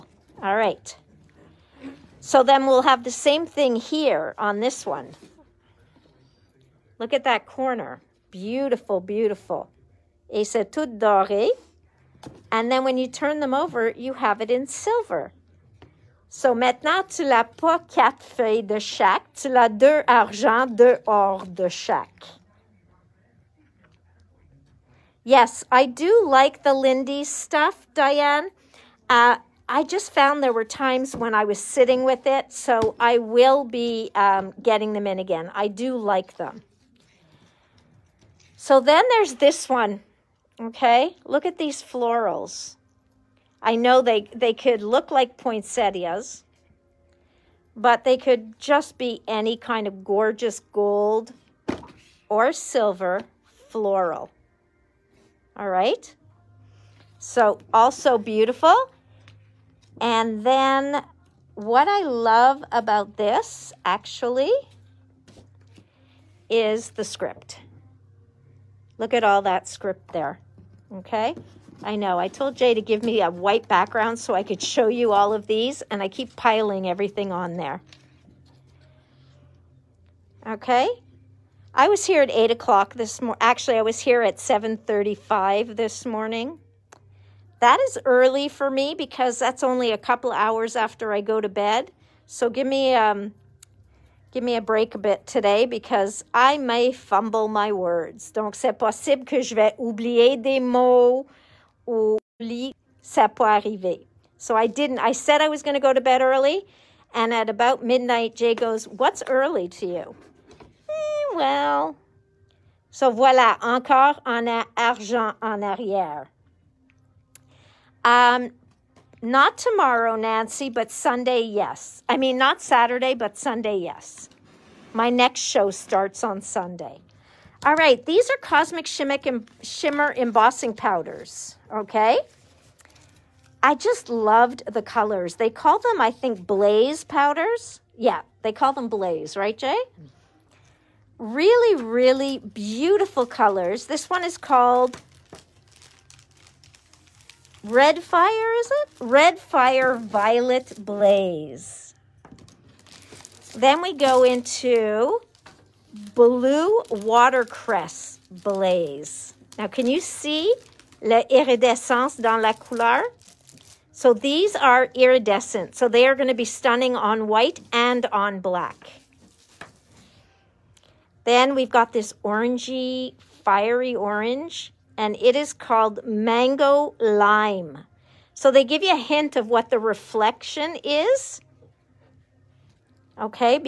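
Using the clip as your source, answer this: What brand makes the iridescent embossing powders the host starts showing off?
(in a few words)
Cosmic Shimmer.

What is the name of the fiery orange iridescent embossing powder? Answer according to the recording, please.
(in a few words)
Mango Lime.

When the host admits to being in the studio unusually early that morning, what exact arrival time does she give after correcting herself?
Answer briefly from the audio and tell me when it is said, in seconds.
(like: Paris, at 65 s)
7:35, at 84 s.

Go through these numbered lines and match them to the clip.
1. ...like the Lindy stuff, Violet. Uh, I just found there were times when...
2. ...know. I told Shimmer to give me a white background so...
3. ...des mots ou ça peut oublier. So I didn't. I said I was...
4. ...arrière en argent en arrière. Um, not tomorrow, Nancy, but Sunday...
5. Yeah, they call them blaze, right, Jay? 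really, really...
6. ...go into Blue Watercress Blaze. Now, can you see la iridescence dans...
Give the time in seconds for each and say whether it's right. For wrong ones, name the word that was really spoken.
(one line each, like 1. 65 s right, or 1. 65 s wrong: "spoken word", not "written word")
1. 26 s wrong: "Diane", not "Violet"
2. 71 s wrong: "Jay", not "Shimmer"
3. 100 s wrong: "arriver", not "oublier"
4. 113 s wrong: "encore", not "arrière"
5. 137 s right
6. 153 s right.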